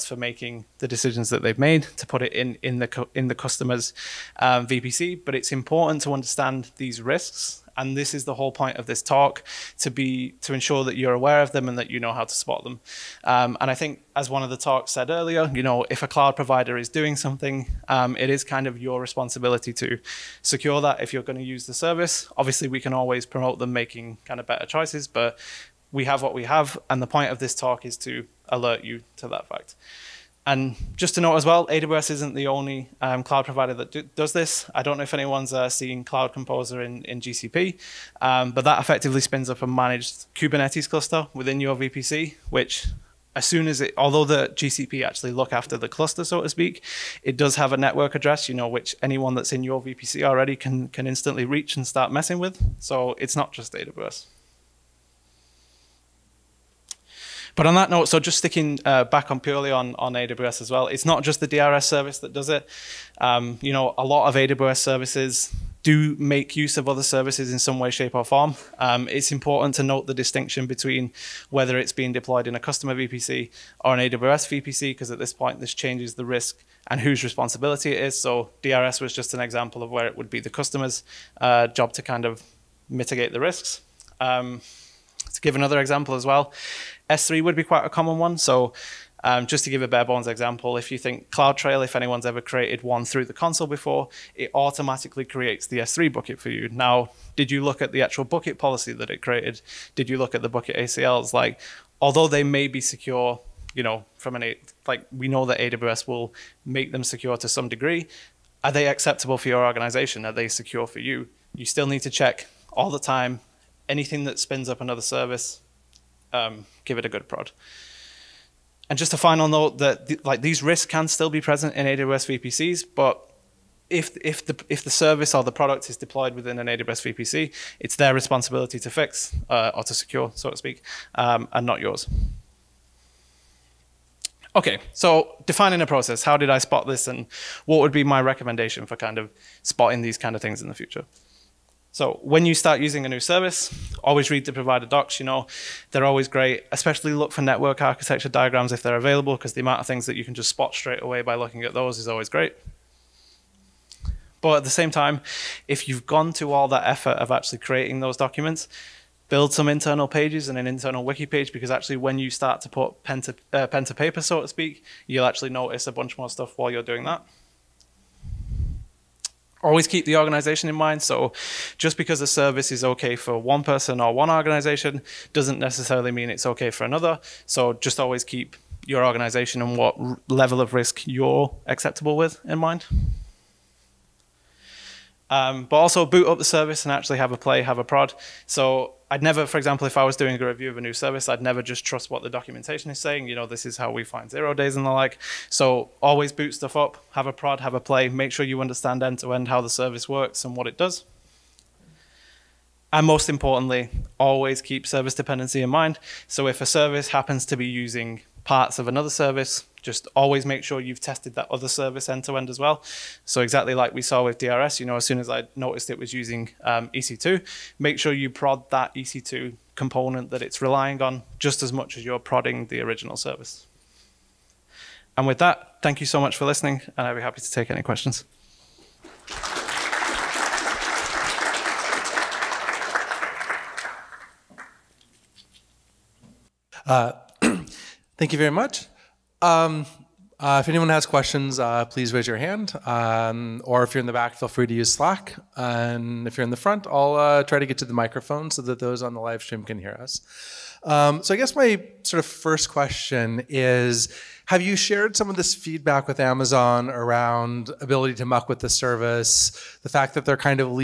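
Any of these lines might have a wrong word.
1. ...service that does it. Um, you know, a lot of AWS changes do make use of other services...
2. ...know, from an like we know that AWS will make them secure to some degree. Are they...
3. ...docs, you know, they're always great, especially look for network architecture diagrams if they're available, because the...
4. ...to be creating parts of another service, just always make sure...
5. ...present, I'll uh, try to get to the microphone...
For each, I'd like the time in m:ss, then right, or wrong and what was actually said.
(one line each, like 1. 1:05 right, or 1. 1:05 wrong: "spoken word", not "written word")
1. 1:01 wrong: "services", not "changes"
2. 1:43 right
3. 2:24 right
4. 3:27 wrong: "using", not "creating"
5. 4:06 wrong: "front", not "present".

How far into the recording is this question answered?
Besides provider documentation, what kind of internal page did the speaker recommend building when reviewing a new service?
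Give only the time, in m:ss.
2:40.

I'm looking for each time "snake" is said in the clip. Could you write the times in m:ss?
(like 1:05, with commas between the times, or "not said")
not said.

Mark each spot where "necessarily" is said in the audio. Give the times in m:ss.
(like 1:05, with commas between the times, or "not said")
2:55.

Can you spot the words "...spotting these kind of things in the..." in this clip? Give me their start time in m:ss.
2:19.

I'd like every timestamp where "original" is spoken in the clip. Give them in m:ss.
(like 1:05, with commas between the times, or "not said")
3:42.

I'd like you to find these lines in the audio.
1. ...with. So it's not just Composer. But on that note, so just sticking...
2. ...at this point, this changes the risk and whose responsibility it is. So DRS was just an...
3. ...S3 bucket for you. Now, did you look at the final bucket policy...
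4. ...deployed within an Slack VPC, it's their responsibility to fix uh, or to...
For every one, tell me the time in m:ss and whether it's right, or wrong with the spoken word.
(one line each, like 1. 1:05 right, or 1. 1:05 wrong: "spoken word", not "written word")
1. 0:52 wrong: "AWS", not "Composer"
2. 1:15 right
3. 1:35 wrong: "actual", not "final"
4. 2:05 wrong: "AWS", not "Slack".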